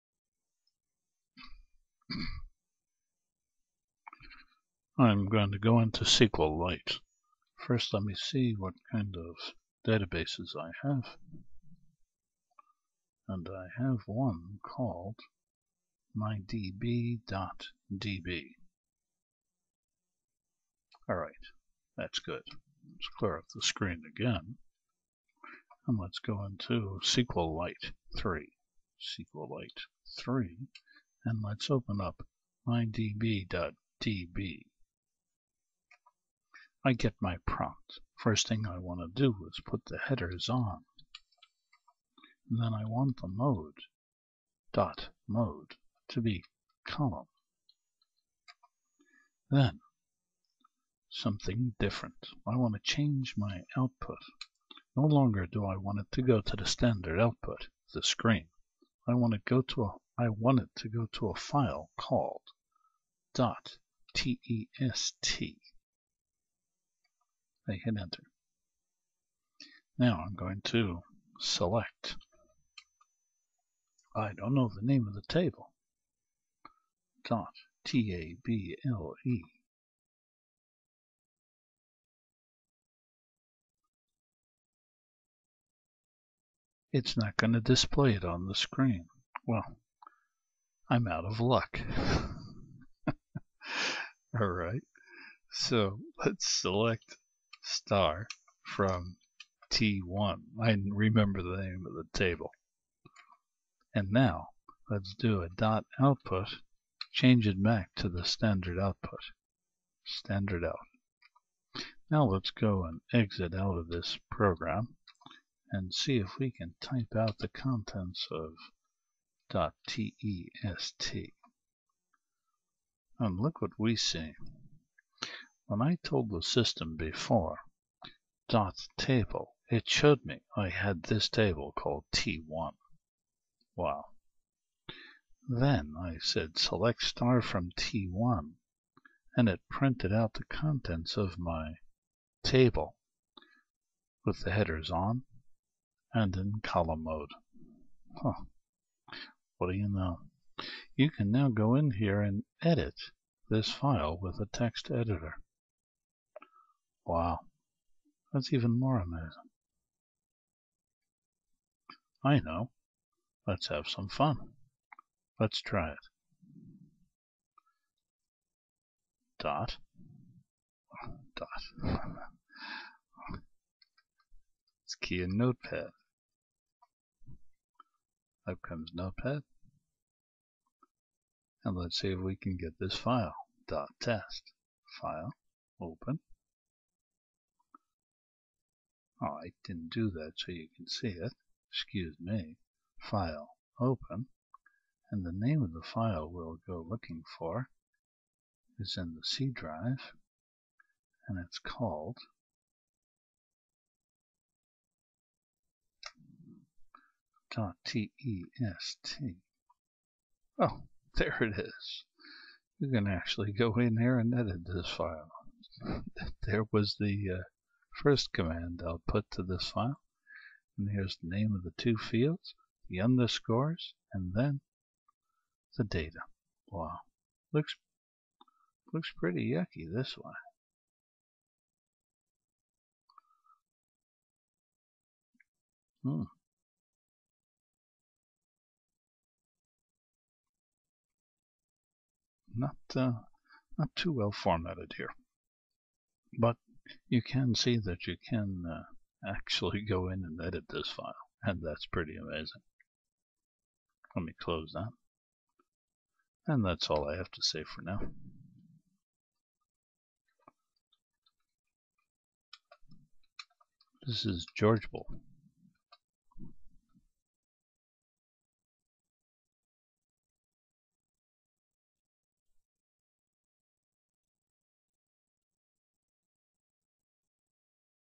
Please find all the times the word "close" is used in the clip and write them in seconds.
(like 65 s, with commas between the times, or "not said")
254 s.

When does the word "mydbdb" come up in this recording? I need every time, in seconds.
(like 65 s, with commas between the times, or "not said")
16 s, 32 s.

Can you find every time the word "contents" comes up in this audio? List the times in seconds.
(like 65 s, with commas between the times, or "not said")
117 s, 140 s.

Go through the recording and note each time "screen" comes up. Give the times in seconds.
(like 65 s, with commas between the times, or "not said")
23 s, 58 s, 88 s.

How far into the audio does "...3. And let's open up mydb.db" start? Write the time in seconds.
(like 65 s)
30 s.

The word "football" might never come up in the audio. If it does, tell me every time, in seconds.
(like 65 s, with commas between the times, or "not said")
not said.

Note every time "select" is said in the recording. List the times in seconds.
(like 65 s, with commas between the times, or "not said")
71 s, 96 s, 136 s.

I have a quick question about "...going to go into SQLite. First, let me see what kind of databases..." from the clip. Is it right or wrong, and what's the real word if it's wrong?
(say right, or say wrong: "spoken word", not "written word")
right.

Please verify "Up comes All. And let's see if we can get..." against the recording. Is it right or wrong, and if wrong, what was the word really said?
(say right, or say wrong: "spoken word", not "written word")
wrong: "Notepad", not "All".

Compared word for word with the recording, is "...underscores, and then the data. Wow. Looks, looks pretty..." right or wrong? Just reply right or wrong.
right.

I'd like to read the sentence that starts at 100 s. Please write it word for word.
I remember the name of the table.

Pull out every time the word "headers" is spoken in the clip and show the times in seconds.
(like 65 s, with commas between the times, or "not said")
39 s, 144 s.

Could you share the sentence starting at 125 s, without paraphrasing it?
When I told the system before dot table, it showed me I had this table called T1.